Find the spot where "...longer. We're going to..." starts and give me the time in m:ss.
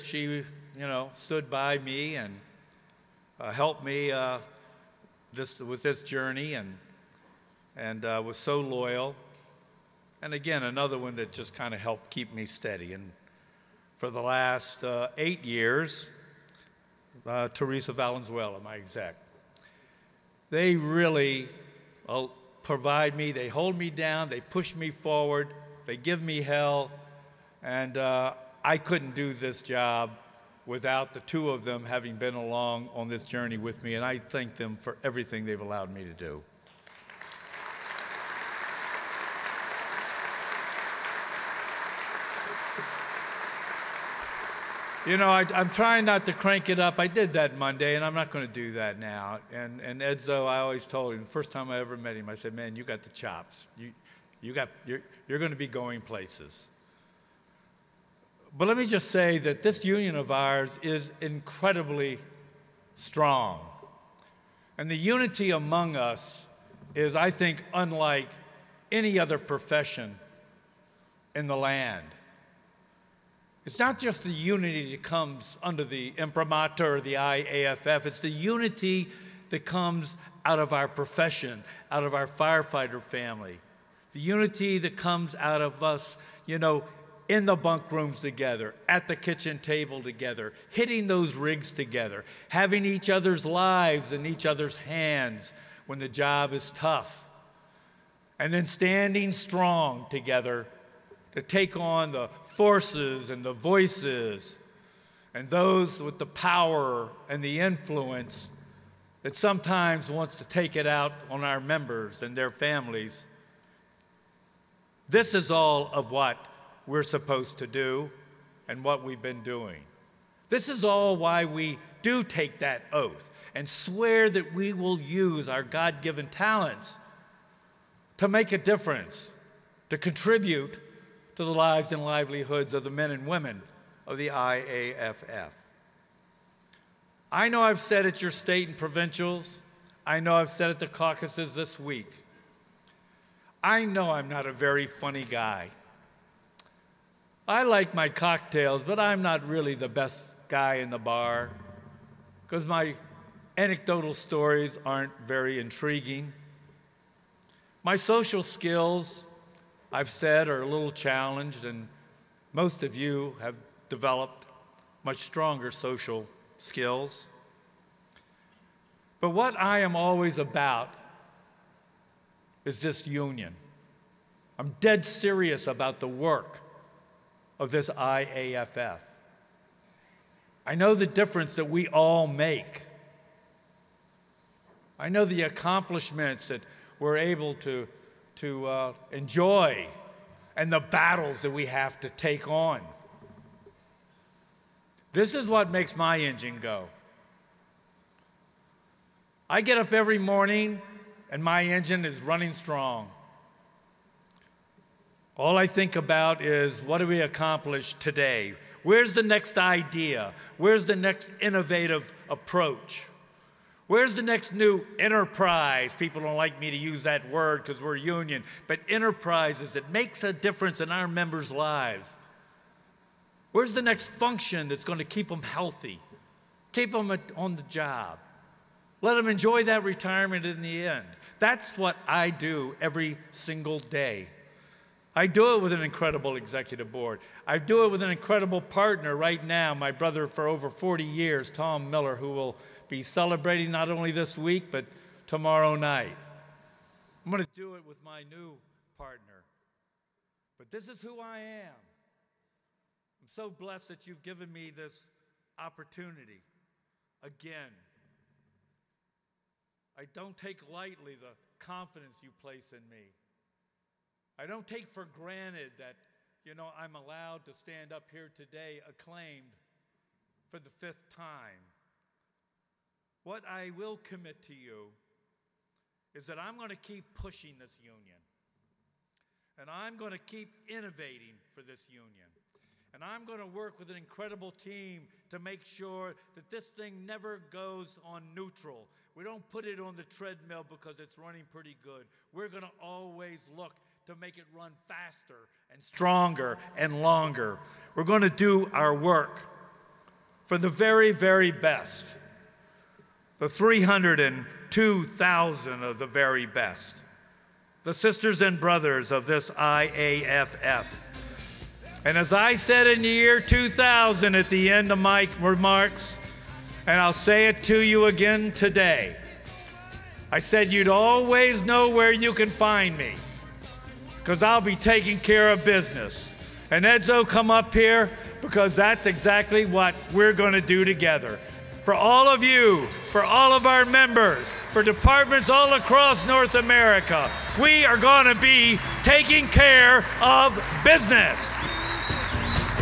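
4:57.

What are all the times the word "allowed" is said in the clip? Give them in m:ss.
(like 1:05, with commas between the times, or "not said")
0:35, 4:26.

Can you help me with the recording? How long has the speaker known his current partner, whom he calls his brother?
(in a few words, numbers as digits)
over 40 years.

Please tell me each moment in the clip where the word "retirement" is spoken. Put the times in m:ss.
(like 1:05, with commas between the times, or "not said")
3:49.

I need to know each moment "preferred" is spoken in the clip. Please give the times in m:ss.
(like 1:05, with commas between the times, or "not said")
not said.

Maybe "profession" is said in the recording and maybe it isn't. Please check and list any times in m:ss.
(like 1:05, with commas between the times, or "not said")
1:09, 1:20.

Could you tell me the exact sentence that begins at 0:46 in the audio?
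I did that Monday, and I'm not going to do that now.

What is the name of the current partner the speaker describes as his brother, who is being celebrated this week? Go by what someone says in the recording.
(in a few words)
Tom Miller.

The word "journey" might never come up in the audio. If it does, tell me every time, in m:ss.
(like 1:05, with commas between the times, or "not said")
0:06, 0:33.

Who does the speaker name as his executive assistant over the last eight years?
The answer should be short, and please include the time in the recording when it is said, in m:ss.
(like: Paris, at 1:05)
Teresa Valenzuela, at 0:17.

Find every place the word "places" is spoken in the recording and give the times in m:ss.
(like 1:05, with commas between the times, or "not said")
0:56, 4:22.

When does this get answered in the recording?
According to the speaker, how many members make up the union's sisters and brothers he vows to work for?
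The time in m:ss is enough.
5:03.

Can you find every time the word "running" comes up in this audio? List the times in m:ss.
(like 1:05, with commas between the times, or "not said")
3:22, 4:51.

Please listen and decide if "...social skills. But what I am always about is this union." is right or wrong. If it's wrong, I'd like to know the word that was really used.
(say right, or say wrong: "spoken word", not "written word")
right.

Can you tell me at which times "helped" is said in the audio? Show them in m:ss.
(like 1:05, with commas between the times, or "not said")
0:03, 0:11.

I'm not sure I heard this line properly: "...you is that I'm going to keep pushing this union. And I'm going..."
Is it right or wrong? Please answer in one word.
right.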